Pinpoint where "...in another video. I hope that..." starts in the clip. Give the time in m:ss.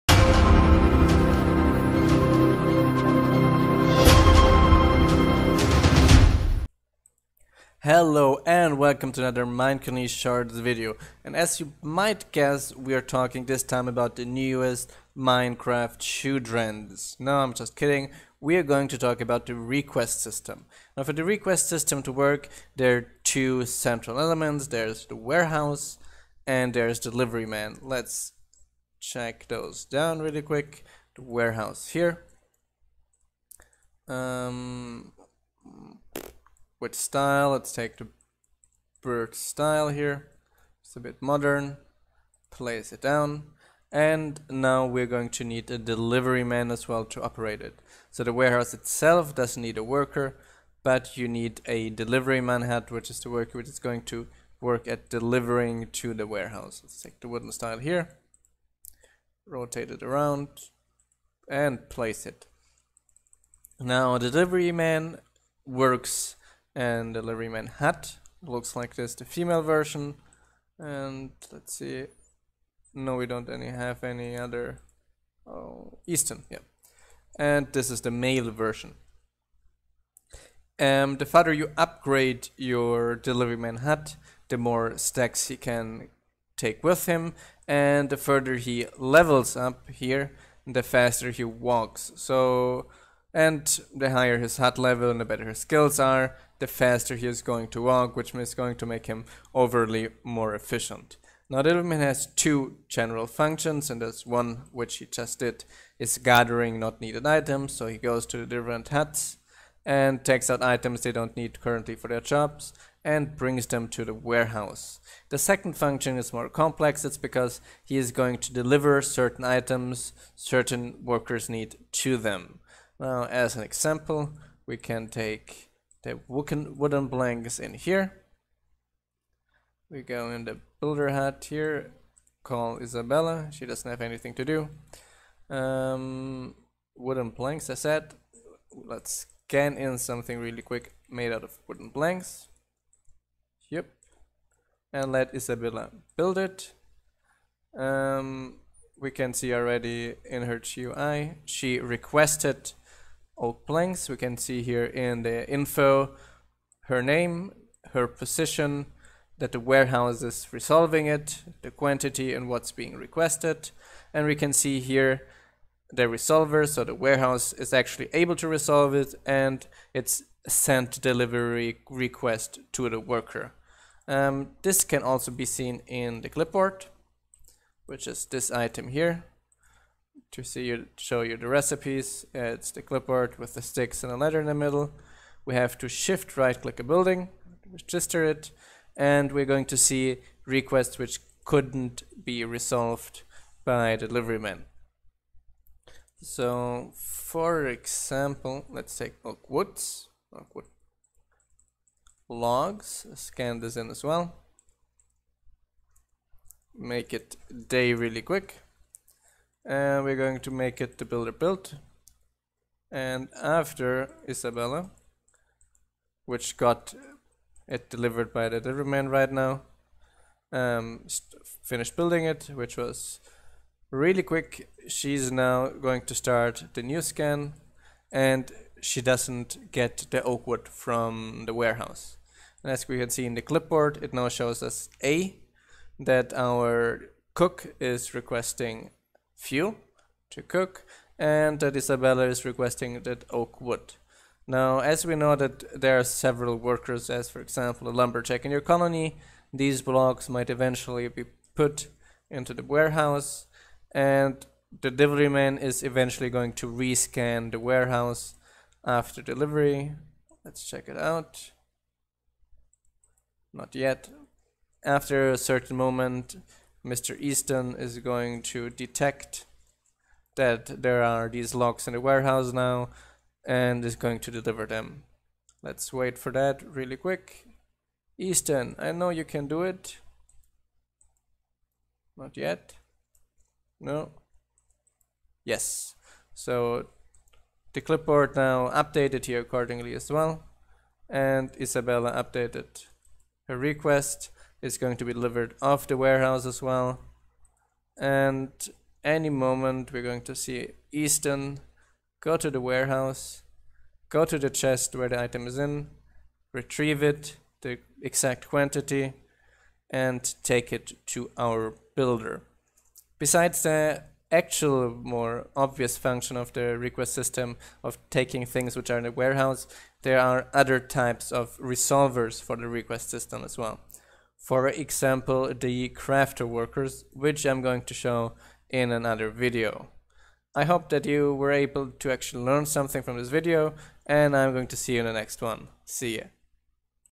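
5:28.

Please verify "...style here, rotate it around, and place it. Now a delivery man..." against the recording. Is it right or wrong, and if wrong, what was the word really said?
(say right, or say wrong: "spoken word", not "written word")
right.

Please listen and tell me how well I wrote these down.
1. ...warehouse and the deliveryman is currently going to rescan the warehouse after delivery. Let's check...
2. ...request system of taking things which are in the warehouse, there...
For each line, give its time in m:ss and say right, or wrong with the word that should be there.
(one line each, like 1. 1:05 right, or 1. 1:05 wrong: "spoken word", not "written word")
1. 4:12 wrong: "eventually", not "currently"
2. 5:16 right.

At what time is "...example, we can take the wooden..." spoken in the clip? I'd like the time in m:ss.
2:03.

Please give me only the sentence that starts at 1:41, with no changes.
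Now man has two general functions and there's one which he just did is gathering not needed items.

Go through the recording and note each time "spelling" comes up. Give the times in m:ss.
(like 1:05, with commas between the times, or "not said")
not said.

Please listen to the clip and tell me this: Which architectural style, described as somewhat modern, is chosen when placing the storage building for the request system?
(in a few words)
Burke.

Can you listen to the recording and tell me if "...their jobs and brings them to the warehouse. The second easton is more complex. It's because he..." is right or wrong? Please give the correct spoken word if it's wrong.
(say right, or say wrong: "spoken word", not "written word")
wrong: "function", not "easton".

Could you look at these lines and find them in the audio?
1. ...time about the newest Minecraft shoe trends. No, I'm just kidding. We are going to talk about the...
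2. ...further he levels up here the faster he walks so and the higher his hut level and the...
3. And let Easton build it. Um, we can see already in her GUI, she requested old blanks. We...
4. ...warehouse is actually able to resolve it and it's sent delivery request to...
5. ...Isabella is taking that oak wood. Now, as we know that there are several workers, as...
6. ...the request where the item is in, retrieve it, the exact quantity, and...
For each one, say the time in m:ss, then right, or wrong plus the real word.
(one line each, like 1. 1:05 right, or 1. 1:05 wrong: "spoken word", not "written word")
1. 0:13 right
2. 1:28 right
3. 2:24 wrong: "Isabella", not "Easton"
4. 2:46 right
5. 4:01 wrong: "requesting", not "taking"
6. 5:04 wrong: "chest", not "request".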